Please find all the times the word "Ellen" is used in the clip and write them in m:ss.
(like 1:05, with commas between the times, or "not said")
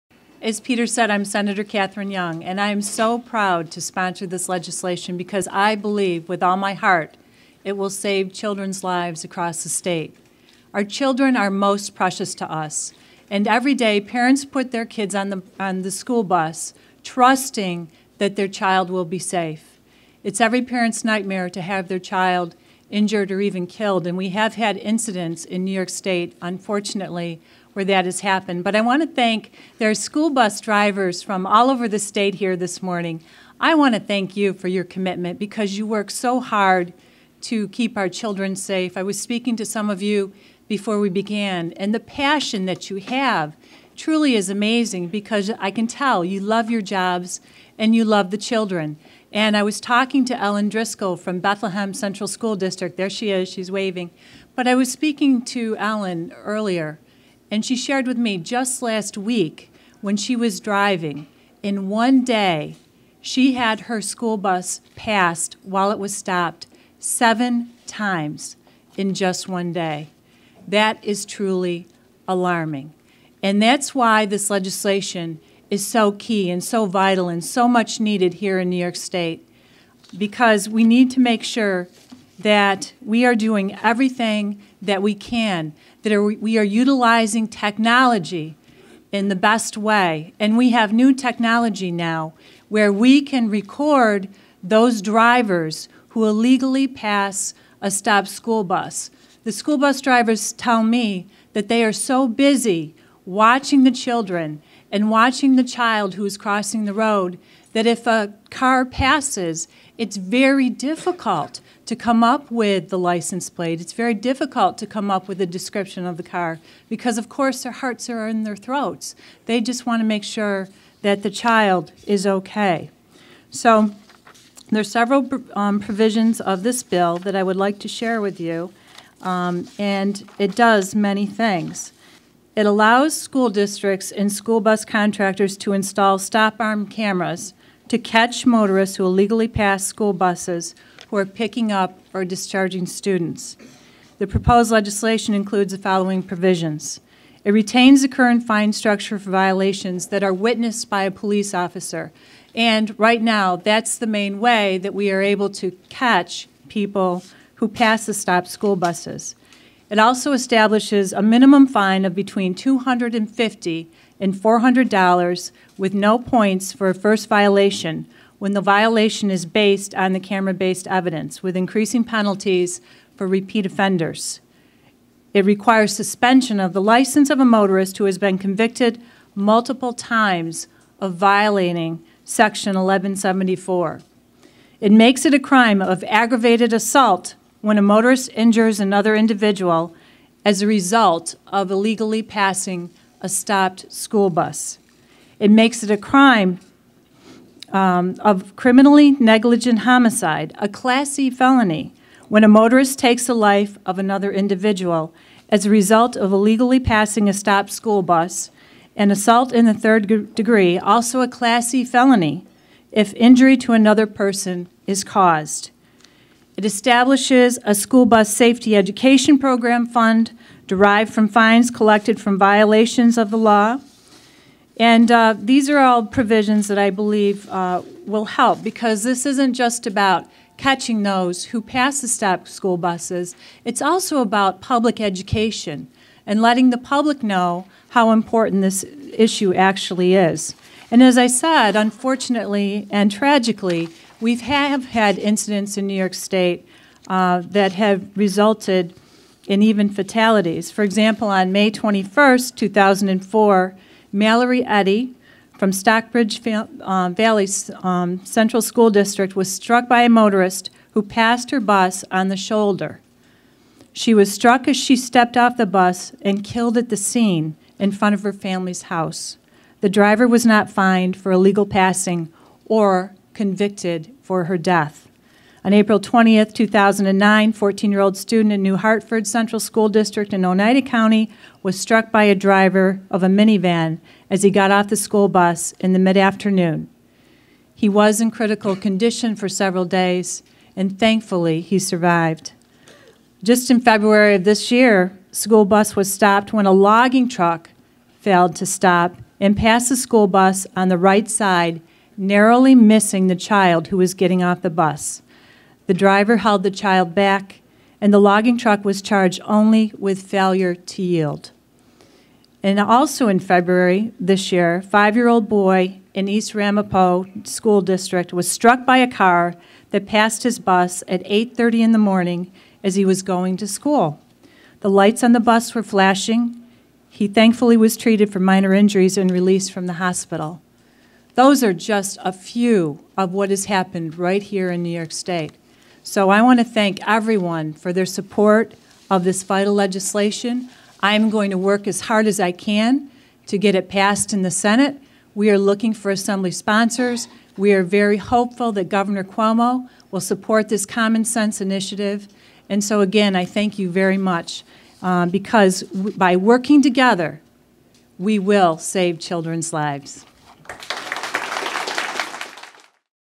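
0:50, 0:55.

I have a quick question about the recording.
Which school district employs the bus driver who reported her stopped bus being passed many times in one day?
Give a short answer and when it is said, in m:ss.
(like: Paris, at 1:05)
Bethlehem Central School District, at 0:51.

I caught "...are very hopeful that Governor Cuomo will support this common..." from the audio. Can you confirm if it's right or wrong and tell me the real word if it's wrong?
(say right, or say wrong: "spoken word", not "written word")
right.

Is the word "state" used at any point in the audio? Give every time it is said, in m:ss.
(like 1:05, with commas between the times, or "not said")
0:09, 0:25, 0:31, 1:18, 4:06, 5:35.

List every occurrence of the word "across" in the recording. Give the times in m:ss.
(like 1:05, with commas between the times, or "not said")
0:09.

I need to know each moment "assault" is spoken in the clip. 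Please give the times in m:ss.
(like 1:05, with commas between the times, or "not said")
3:06, 3:29.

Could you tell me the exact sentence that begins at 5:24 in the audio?
The lights on the bus were flashing.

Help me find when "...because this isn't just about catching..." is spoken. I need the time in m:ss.
3:48.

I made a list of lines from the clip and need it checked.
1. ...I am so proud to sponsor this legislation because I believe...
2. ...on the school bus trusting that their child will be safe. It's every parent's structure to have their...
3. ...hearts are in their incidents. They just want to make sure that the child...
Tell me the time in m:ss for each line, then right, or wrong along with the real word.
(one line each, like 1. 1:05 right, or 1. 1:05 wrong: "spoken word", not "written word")
1. 0:02 right
2. 0:15 wrong: "nightmare", not "structure"
3. 1:57 wrong: "throats", not "incidents".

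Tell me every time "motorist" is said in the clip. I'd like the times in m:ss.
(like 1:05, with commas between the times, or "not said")
2:18, 2:57, 3:07, 3:22, 4:20.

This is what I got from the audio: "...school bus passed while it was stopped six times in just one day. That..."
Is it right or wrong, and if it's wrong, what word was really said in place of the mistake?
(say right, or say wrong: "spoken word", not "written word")
wrong: "seven", not "six".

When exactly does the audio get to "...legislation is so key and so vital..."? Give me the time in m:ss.
1:14.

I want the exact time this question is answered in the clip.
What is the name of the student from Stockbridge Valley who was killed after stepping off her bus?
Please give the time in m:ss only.
4:14.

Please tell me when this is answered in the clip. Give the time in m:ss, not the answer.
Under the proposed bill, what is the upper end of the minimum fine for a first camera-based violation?
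2:44.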